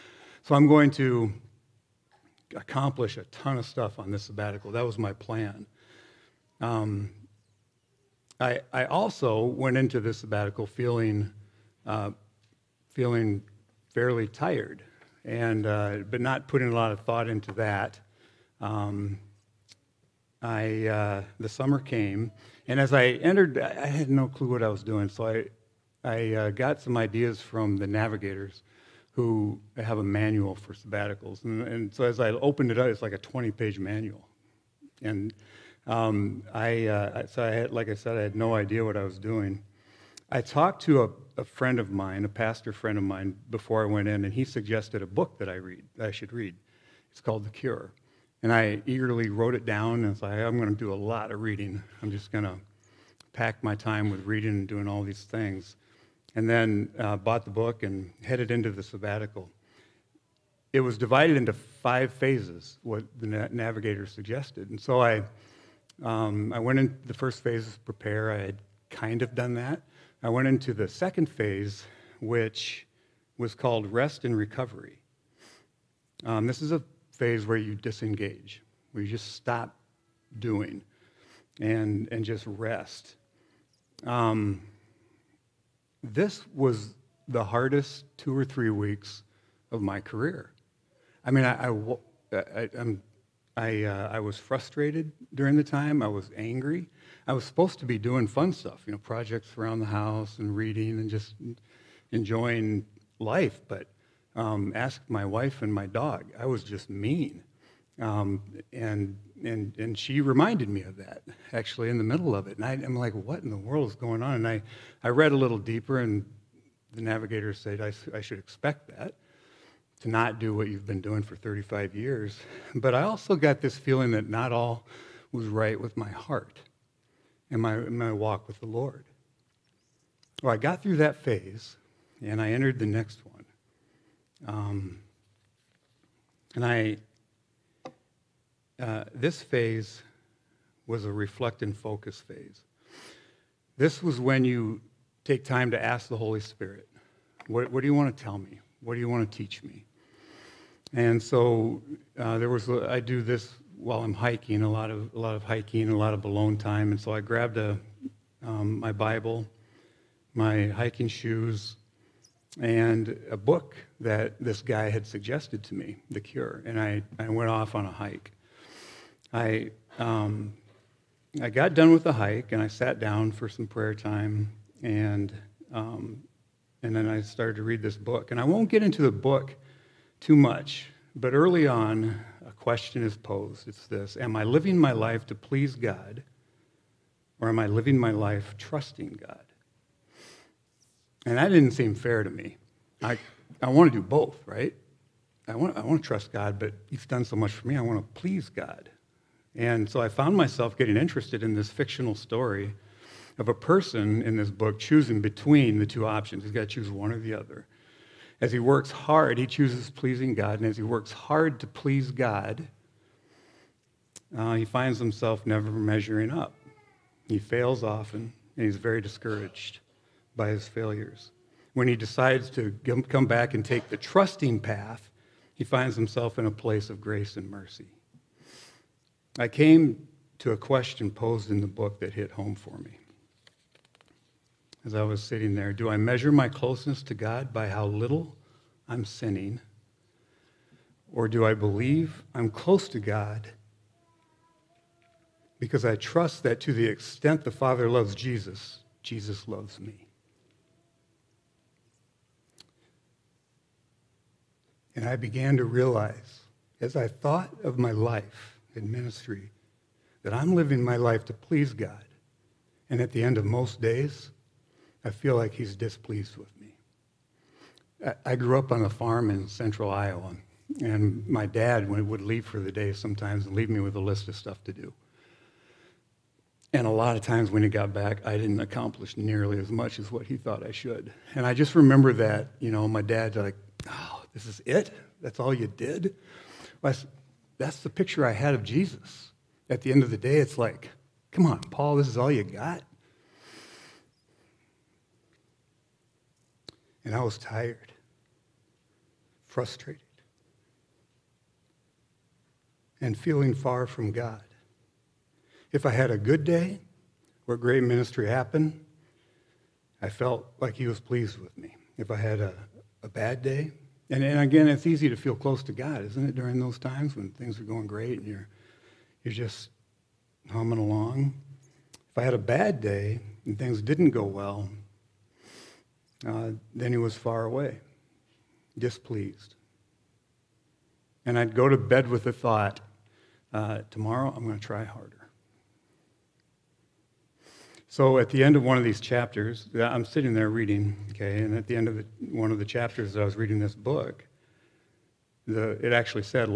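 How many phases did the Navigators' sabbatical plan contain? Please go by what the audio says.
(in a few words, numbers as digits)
5.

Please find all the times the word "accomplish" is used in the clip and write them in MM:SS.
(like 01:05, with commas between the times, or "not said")
00:02, 04:38.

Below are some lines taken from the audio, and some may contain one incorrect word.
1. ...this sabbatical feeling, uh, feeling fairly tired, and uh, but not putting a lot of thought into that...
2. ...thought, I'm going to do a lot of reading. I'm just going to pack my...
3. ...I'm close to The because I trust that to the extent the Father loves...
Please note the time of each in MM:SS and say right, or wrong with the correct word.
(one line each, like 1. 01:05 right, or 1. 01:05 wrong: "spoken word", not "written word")
1. 00:09 right
2. 00:50 right
3. 04:02 wrong: "God", not "The".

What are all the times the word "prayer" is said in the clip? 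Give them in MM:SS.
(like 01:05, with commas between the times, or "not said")
02:53.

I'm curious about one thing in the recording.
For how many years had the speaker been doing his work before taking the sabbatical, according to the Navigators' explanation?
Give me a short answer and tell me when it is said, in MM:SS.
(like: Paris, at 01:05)
35, at 02:01.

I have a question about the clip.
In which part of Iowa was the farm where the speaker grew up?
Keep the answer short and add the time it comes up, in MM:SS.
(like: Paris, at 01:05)
central Iowa, at 04:29.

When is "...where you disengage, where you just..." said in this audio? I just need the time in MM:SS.
01:17.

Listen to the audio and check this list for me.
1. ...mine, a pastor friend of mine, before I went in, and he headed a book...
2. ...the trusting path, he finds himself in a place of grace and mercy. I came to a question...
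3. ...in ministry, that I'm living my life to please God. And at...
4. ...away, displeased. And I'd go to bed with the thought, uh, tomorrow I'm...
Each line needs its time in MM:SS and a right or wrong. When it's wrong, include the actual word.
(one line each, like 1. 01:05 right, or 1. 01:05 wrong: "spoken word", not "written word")
1. 00:41 wrong: "suggested", not "headed"
2. 03:43 right
3. 04:18 right
4. 05:27 right.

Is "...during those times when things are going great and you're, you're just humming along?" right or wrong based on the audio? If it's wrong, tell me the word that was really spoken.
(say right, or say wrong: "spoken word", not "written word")
right.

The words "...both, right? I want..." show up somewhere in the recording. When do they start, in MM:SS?
03:14.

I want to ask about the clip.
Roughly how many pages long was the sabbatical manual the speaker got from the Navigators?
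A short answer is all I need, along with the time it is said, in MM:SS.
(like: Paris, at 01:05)
20, at 00:33.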